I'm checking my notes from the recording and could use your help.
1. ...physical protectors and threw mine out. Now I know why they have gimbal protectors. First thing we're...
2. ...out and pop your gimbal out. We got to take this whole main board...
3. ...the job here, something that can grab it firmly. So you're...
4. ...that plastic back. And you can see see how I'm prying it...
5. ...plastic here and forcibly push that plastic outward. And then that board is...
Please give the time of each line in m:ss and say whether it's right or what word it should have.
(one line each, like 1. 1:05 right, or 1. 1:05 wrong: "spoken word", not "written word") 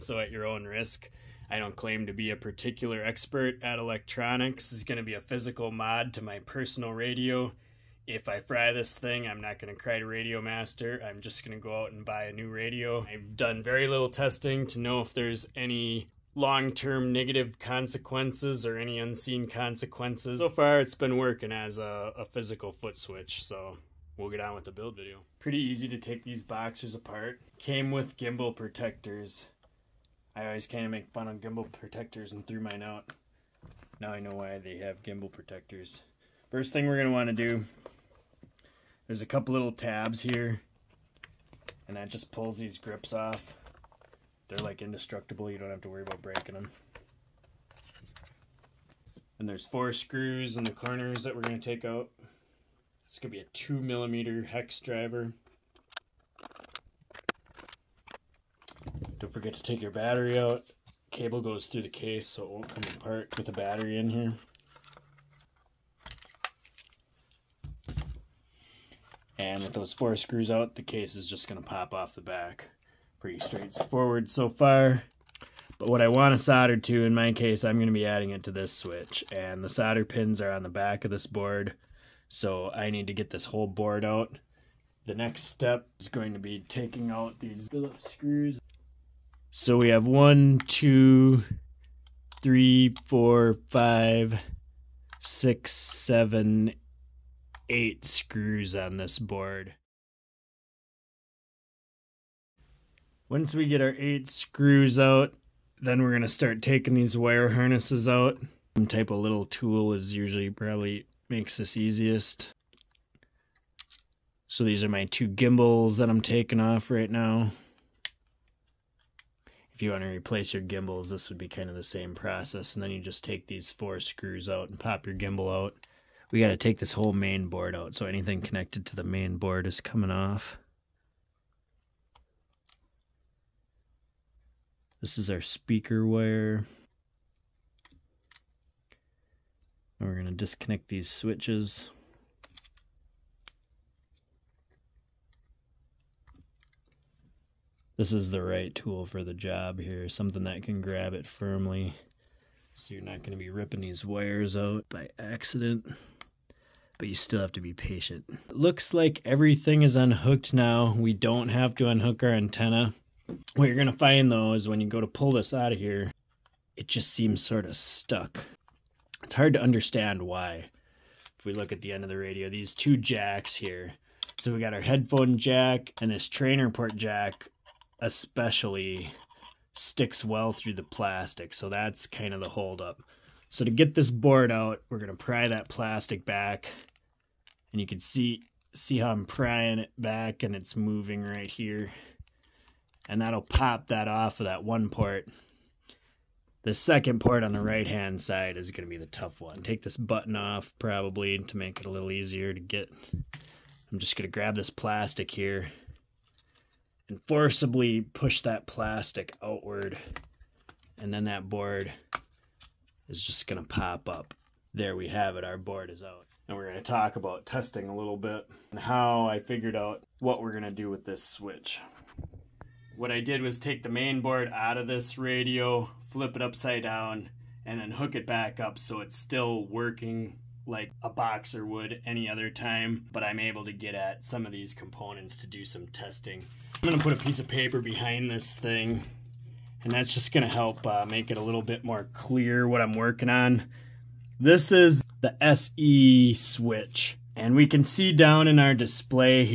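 1. 0:31 wrong: "gimbal", not "physical"
2. 2:04 right
3. 2:29 right
4. 3:05 right
5. 3:24 right.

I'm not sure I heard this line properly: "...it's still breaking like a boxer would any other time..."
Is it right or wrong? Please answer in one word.
wrong.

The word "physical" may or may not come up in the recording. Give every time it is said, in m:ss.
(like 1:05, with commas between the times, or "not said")
0:05, 0:22.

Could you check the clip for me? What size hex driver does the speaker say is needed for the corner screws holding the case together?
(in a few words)
2 millimeter.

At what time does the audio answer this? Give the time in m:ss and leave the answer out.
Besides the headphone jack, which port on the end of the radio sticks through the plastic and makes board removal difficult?
2:56.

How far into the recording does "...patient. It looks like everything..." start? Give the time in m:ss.
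2:37.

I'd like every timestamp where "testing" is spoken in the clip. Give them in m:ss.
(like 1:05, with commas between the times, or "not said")
0:14, 3:37, 3:55.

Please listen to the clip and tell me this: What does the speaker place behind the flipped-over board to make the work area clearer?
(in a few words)
a piece of paper.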